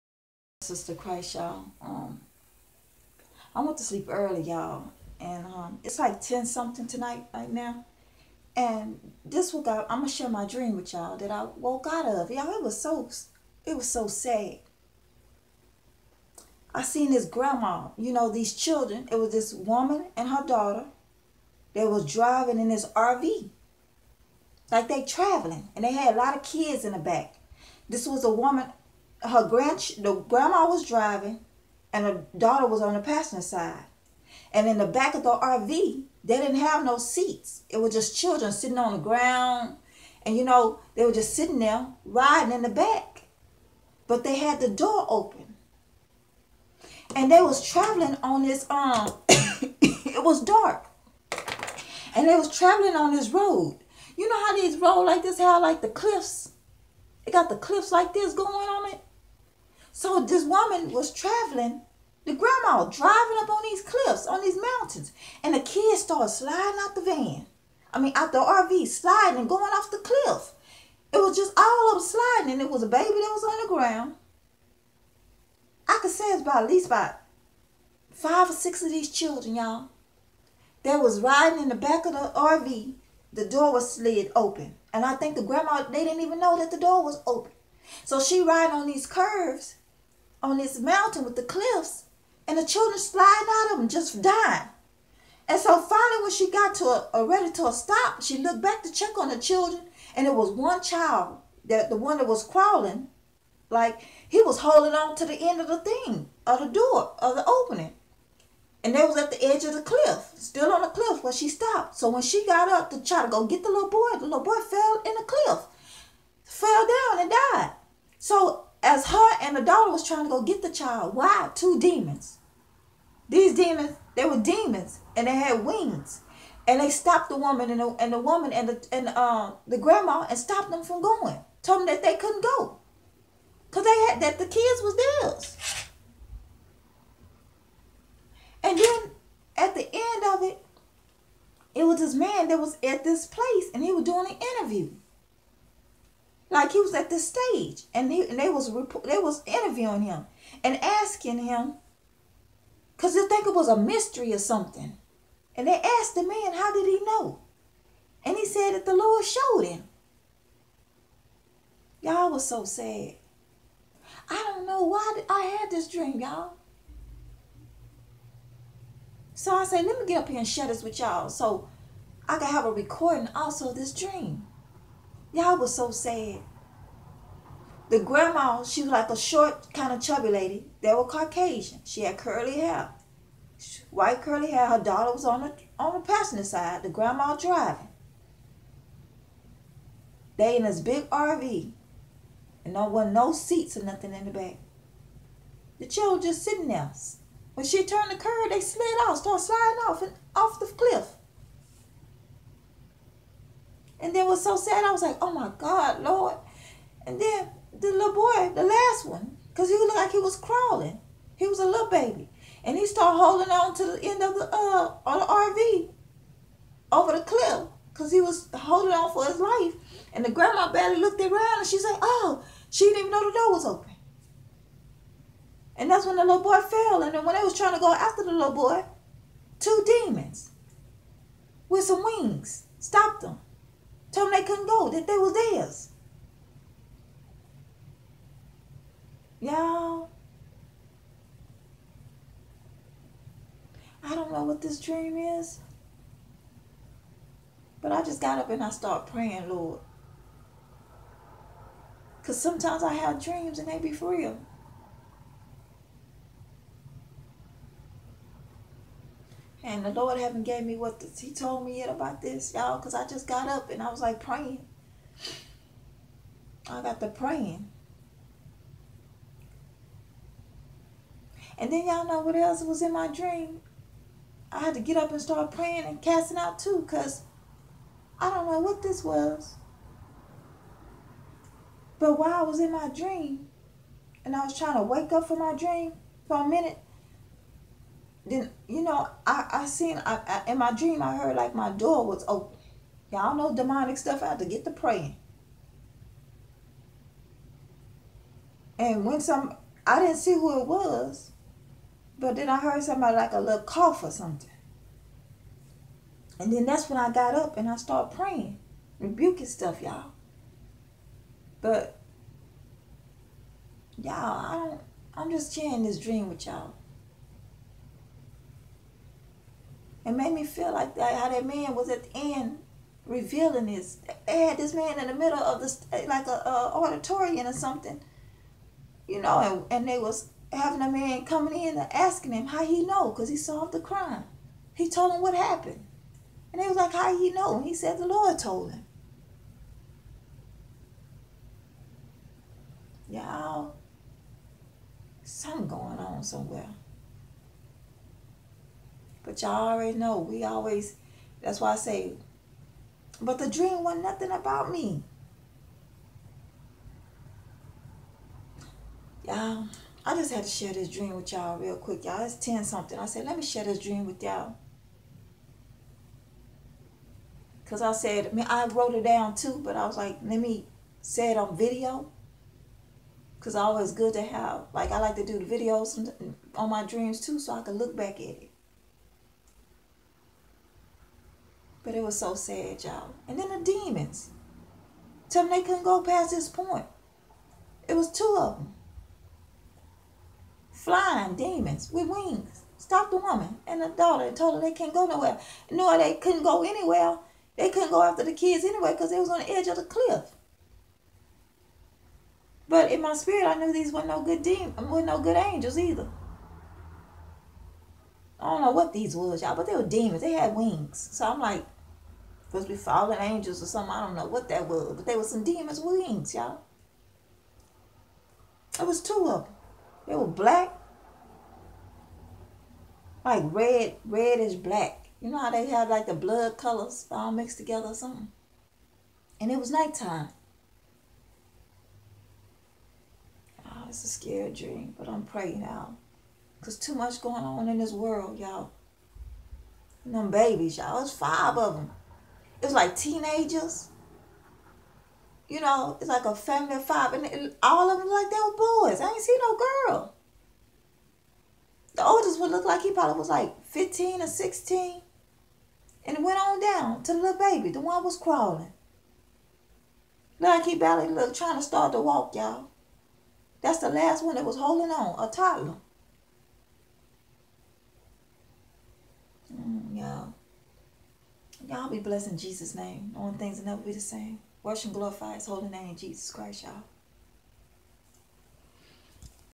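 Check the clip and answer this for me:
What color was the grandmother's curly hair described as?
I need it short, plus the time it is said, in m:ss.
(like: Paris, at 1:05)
White, at 3:03.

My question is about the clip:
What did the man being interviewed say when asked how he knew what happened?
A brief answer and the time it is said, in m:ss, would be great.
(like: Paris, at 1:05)
The Lord showed him, at 2:38.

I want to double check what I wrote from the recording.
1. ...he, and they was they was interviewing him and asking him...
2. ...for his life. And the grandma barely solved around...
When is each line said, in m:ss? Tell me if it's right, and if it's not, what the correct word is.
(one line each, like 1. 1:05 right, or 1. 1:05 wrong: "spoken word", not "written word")
1. 2:28 right
2. 3:39 wrong: "looked", not "solved".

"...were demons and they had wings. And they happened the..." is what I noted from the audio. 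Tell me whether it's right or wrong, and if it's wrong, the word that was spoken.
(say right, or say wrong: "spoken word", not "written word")
wrong: "stopped", not "happened".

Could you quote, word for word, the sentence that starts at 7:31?
The oldest would look like he probably was like fifteen or sixteen, and it went on down to the little baby.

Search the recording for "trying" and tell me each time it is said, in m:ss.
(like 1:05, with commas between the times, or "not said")
2:00, 3:47, 4:44, 7:41.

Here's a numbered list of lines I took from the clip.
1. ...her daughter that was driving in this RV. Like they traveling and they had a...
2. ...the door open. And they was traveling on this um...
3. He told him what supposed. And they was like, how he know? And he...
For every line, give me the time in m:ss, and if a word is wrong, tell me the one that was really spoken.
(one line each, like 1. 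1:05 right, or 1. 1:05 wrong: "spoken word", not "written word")
1. 0:20 right
2. 0:44 right
3. 5:34 wrong: "happened", not "supposed".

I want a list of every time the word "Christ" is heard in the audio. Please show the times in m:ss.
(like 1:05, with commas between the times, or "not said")
0:00, 7:56.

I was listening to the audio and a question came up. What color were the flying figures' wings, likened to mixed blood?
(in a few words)
Reddish black.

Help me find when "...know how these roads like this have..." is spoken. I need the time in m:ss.
0:54.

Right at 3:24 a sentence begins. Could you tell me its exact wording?
And then was so sad, I was like, oh my God, Lord.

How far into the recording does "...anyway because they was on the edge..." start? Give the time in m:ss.
6:38.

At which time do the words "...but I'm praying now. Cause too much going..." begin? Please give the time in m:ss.
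7:14.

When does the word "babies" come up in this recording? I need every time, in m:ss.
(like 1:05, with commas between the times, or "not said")
7:20.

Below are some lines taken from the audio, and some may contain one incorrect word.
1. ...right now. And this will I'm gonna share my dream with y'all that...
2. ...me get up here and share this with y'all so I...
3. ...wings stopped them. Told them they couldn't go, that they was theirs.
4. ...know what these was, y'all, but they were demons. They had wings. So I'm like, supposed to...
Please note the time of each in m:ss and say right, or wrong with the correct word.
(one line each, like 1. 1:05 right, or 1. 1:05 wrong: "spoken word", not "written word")
1. 0:07 right
2. 2:49 right
3. 3:52 right
4. 6:48 right.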